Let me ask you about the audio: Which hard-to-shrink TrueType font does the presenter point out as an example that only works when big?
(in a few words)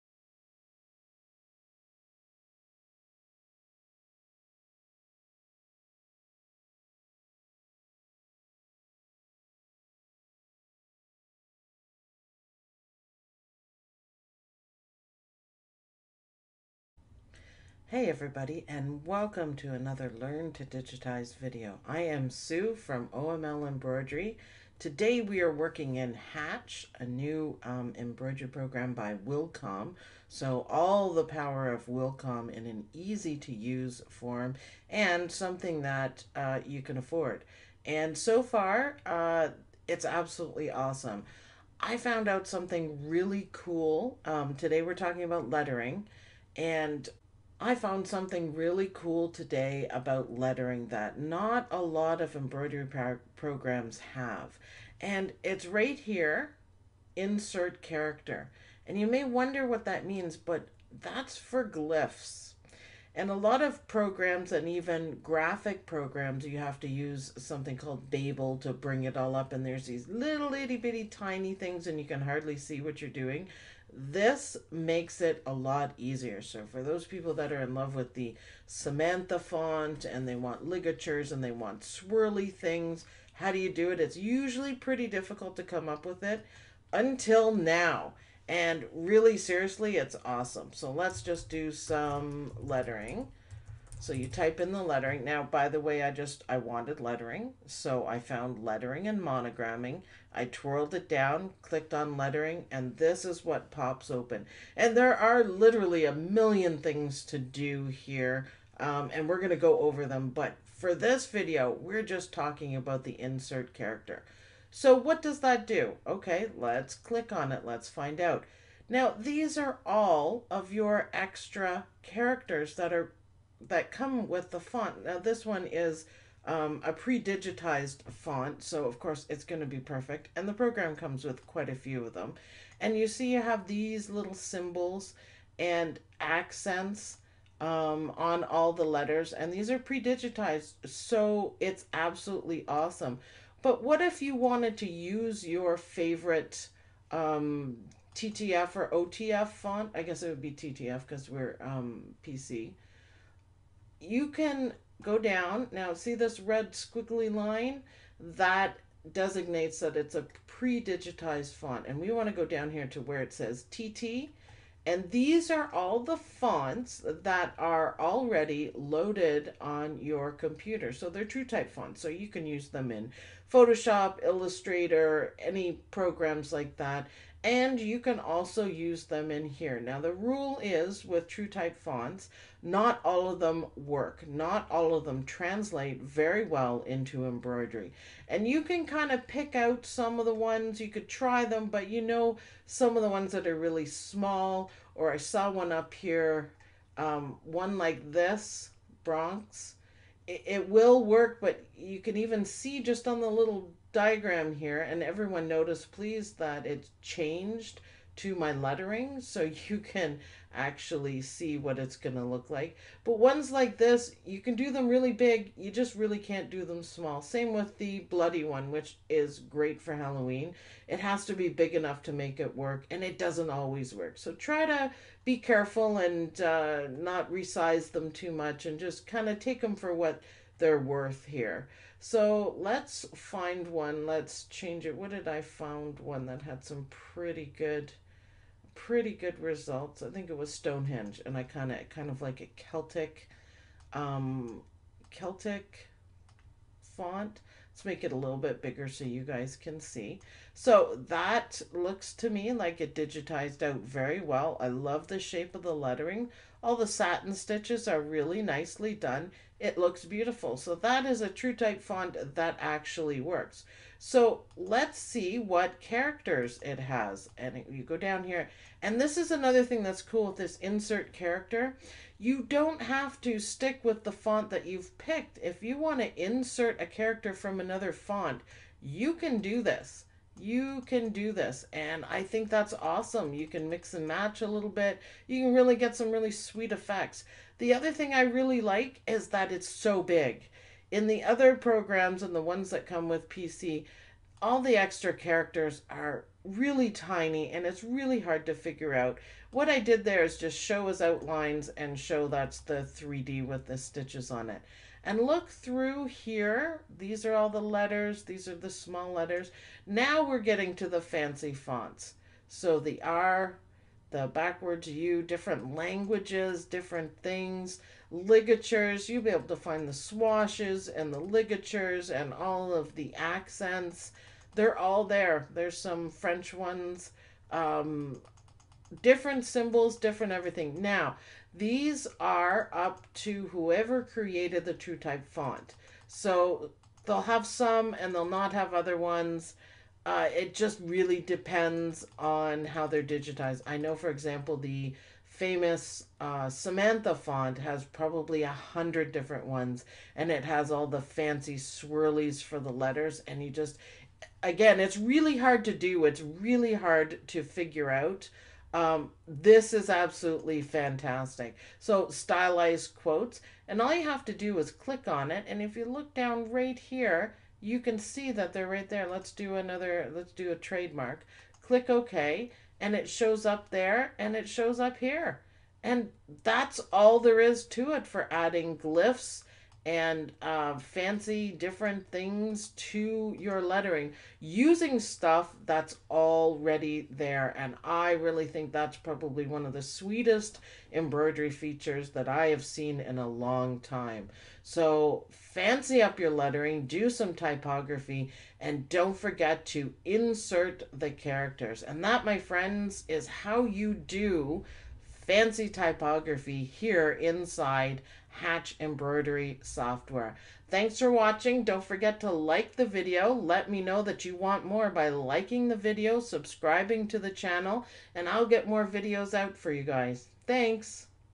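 Bronx.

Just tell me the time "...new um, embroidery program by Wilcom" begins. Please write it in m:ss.
0:27.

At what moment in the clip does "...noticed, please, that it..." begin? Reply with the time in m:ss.
3:25.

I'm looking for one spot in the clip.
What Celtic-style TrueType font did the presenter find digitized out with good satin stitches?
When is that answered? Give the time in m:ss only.
4:00.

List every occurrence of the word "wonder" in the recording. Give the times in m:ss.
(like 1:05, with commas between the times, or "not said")
0:59.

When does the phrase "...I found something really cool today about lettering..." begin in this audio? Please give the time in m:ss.
0:47.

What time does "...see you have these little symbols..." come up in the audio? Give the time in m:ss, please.
2:13.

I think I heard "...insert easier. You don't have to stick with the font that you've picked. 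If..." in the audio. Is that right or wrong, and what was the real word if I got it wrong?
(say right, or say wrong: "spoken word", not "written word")
wrong: "character", not "easier".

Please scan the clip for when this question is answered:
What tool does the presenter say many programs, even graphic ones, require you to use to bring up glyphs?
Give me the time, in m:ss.
1:08.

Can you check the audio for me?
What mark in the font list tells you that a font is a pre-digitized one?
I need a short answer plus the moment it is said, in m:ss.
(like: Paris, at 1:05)
red squiggly line, at 2:36.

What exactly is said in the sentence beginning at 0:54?
And it's right here, insert character.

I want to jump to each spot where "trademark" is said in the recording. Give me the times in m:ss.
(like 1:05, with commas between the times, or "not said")
6:10.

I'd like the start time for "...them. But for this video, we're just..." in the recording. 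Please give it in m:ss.
1:50.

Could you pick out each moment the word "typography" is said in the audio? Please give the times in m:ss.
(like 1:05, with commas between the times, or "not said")
6:37, 6:45.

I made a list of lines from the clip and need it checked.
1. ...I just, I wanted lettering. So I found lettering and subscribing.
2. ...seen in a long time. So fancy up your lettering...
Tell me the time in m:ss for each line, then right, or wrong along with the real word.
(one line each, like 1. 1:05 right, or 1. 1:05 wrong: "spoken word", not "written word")
1. 1:36 wrong: "monogramming", not "subscribing"
2. 6:32 right.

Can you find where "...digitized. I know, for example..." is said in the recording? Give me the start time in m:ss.
5:43.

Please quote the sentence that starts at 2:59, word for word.
Now the rule is with TrueType fonts, not all of them work.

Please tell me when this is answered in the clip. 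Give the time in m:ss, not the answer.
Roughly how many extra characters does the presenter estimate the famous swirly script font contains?
5:48.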